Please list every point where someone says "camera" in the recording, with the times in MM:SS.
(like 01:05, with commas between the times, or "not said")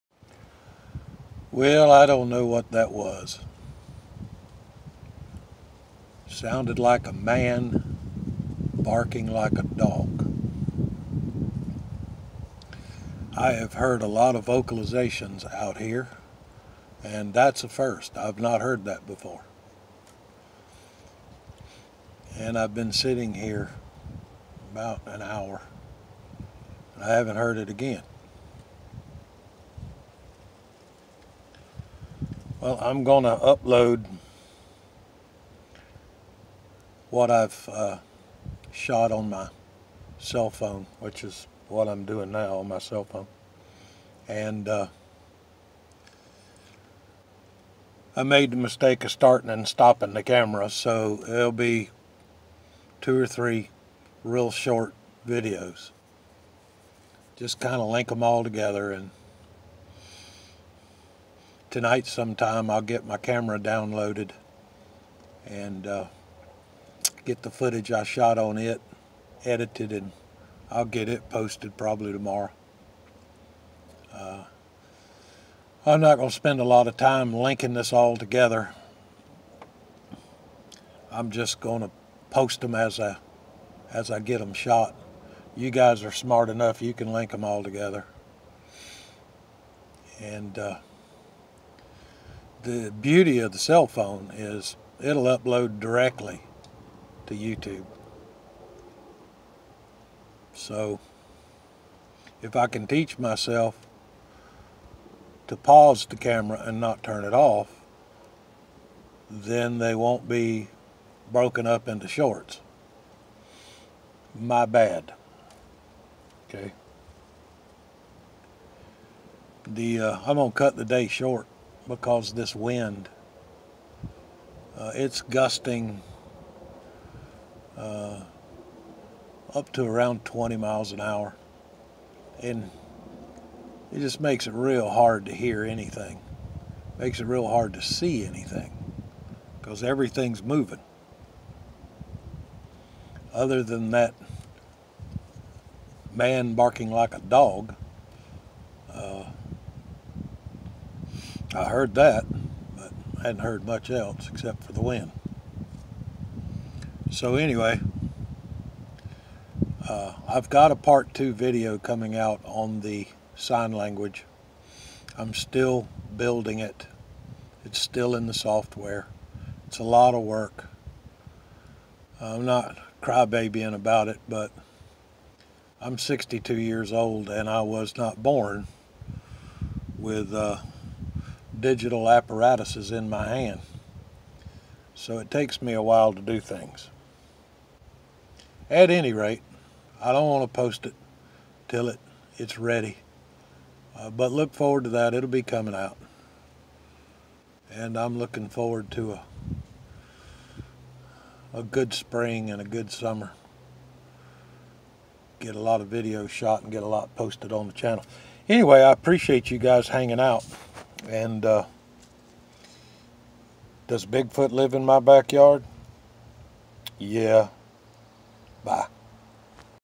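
00:50, 01:03, 01:46.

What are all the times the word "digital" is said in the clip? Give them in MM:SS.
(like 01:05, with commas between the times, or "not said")
03:01.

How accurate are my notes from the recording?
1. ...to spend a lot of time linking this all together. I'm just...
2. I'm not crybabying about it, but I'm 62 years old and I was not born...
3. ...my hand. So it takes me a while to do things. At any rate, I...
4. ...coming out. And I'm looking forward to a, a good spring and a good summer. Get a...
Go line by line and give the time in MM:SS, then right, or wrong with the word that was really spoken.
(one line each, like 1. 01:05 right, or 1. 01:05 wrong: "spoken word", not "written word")
1. 01:16 right
2. 02:52 right
3. 03:03 right
4. 03:15 right.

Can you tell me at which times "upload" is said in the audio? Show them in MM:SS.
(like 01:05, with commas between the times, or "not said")
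00:33, 01:35.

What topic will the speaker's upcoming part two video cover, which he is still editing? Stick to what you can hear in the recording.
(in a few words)
Sign language.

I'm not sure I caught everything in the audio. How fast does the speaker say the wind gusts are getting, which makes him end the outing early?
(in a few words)
20 miles an hour.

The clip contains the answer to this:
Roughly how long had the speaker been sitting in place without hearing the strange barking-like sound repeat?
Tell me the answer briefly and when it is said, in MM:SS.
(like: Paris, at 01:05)
About an hour, at 00:24.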